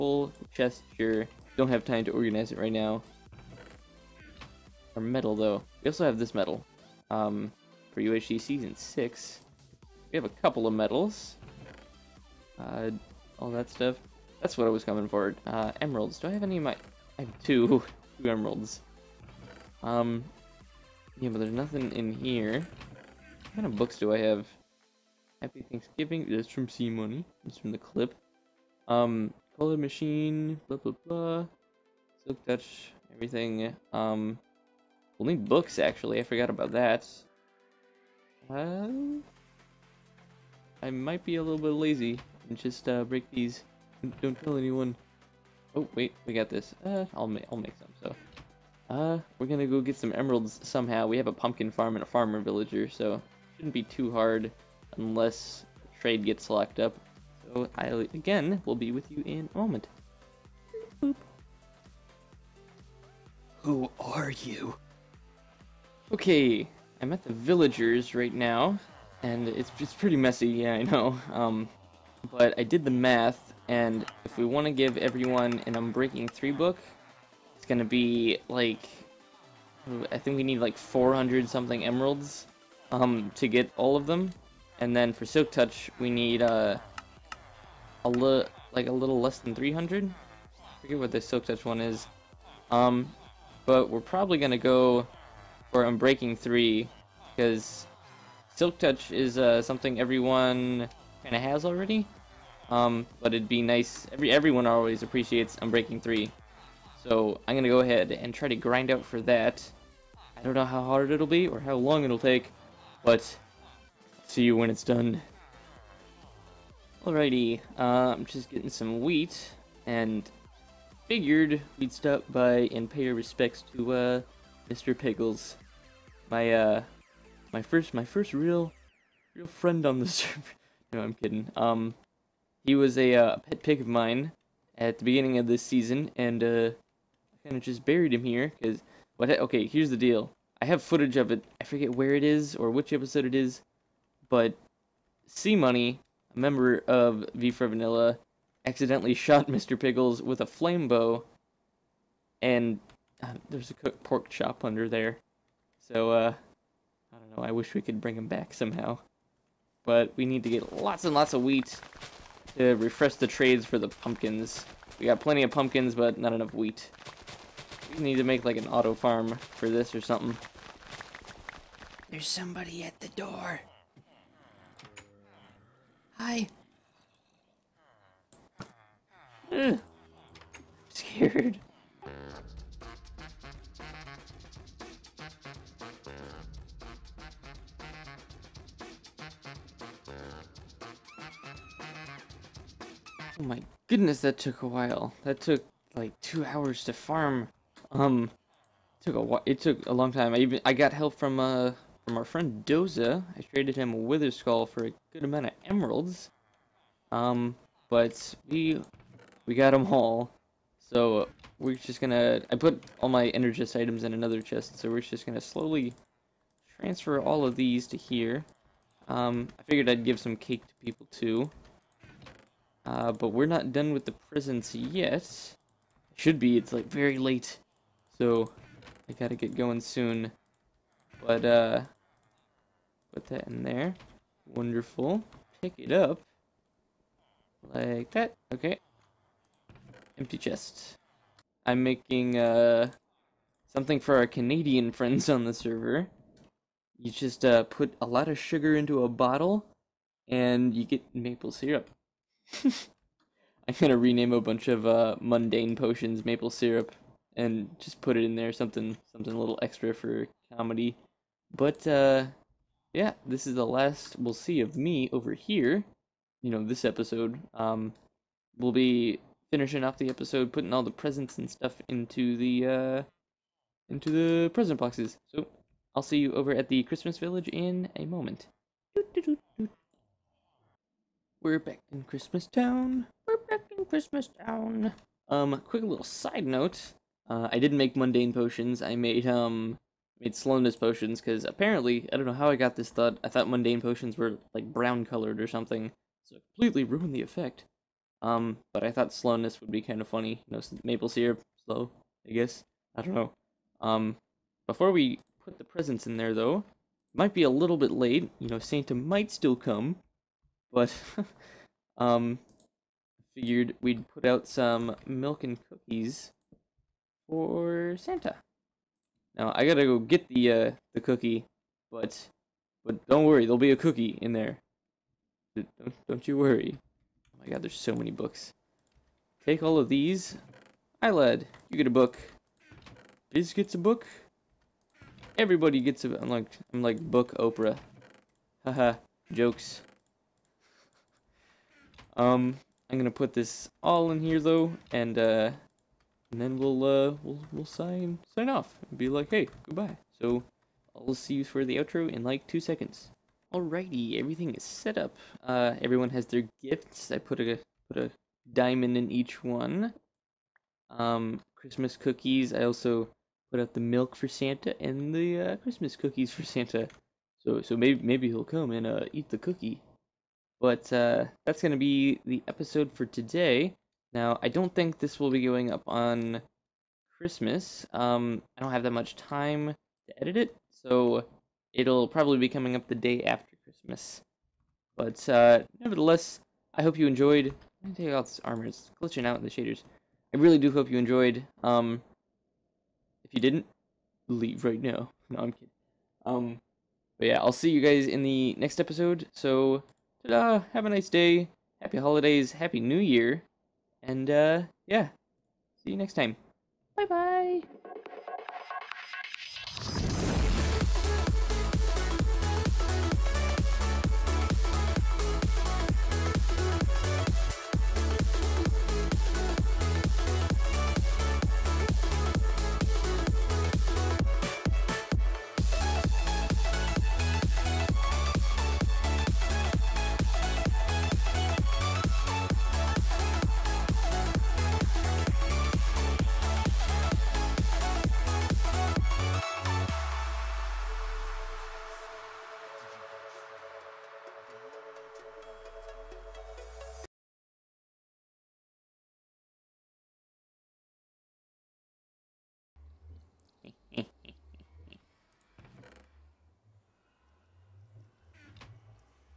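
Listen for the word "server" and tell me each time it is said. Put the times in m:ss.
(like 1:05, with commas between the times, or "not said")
2:10, 4:05.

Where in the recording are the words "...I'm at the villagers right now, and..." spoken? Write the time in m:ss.
1:07.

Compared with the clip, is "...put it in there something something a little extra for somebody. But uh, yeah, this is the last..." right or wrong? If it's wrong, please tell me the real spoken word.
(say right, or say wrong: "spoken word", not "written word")
wrong: "comedy", not "somebody".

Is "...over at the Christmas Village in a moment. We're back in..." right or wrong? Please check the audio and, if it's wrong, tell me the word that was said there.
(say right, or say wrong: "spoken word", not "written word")
right.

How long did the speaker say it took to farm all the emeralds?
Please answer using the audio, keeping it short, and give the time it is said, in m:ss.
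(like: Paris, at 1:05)
2 hours, at 3:16.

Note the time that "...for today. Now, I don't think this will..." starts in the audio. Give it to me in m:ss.
6:12.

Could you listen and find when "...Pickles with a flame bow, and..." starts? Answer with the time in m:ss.
2:29.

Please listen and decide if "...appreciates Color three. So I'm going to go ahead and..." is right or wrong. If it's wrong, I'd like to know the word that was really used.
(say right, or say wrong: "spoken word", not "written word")
wrong: "Unbreaking", not "Color".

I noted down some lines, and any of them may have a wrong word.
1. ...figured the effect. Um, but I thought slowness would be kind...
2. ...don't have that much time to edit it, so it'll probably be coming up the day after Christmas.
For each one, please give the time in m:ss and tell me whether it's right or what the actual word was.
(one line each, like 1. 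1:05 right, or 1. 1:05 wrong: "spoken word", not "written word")
1. 4:56 wrong: "ruined", not "figured"
2. 6:18 right.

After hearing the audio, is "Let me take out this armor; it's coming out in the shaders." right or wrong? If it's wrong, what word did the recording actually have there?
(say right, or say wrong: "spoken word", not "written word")
wrong: "glitching", not "coming".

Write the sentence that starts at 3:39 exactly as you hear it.
Um, I figured I'd give some cake to people too.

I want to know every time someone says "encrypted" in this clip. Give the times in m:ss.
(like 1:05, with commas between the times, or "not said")
not said.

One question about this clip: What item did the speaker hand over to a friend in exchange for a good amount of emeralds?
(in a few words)
Wither Skull.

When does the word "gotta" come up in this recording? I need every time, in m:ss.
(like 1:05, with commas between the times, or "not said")
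3:49, 5:19.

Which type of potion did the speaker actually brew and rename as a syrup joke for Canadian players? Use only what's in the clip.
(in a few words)
Slowness potions.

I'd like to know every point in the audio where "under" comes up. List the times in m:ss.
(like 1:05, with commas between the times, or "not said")
2:34.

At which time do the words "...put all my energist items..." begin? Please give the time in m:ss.
3:32.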